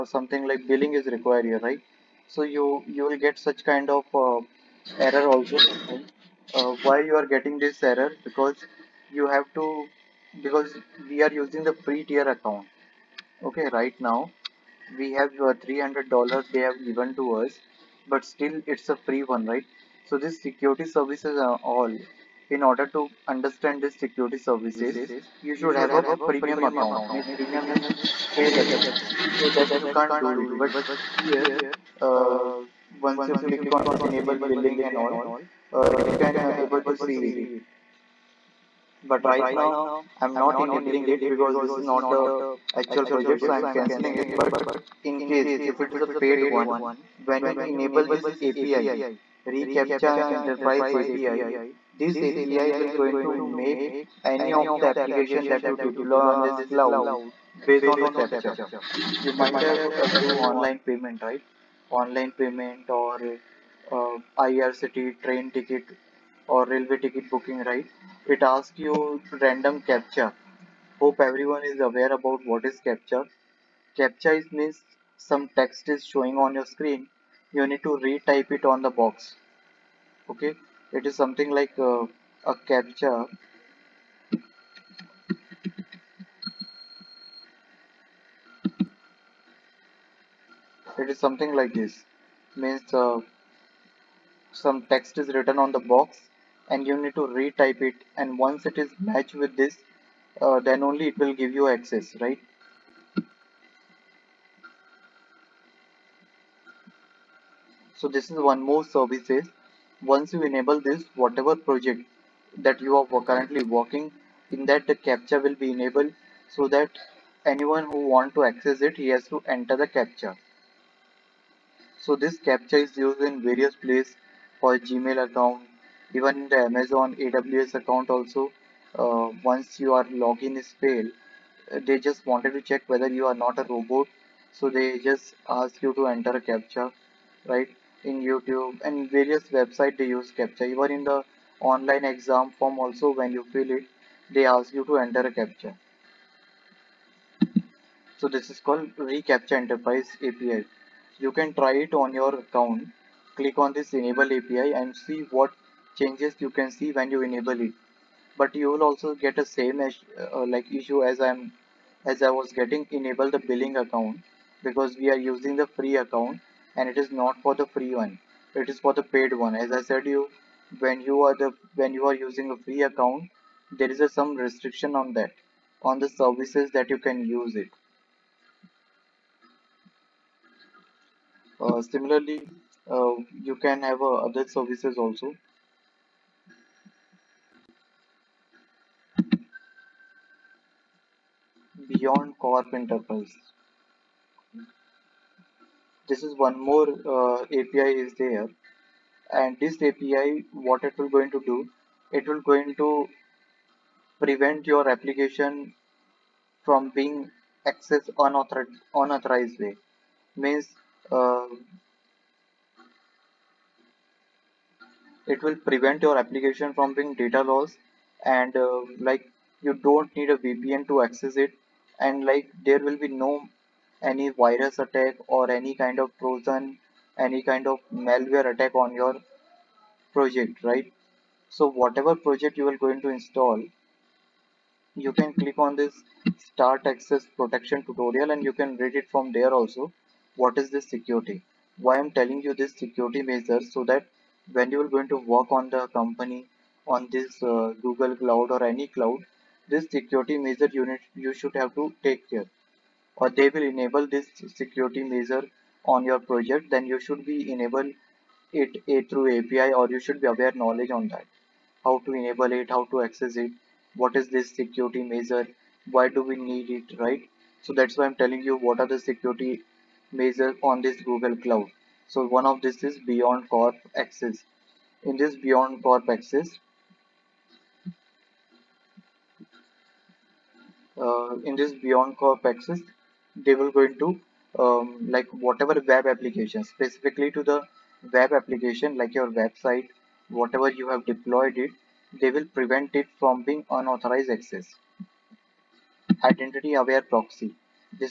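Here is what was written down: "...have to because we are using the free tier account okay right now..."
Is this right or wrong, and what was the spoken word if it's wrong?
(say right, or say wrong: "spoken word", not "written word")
right.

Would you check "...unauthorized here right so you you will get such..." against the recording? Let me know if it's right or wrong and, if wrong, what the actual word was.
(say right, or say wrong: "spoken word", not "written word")
wrong: "required", not "unauthorized".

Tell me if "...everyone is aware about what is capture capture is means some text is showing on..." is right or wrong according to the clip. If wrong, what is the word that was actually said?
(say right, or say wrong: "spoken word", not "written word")
right.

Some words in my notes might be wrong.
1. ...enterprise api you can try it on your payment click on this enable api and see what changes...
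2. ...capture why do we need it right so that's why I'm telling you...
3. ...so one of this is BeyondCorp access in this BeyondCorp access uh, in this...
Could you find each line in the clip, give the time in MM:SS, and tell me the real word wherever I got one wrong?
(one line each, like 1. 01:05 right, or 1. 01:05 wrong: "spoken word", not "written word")
1. 02:29 wrong: "account", not "payment"
2. 04:25 wrong: "measure", not "capture"
3. 04:32 right.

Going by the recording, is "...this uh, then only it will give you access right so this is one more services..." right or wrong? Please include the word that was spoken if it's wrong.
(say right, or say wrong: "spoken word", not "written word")
right.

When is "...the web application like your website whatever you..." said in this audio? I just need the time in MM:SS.
04:47.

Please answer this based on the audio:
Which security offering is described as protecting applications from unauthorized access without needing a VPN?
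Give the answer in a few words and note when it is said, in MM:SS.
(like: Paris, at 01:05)
BeyondCorp Enterprise, at 03:11.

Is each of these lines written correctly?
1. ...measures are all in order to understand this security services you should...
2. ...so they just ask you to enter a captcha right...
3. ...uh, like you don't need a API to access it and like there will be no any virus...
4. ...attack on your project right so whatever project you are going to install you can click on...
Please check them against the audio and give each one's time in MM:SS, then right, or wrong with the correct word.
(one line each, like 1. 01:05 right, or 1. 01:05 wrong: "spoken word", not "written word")
1. 00:20 wrong: "services", not "measures"
2. 02:14 right
3. 03:38 wrong: "VPN", not "API"
4. 03:48 right.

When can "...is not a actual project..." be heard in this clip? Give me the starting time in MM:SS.
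00:41.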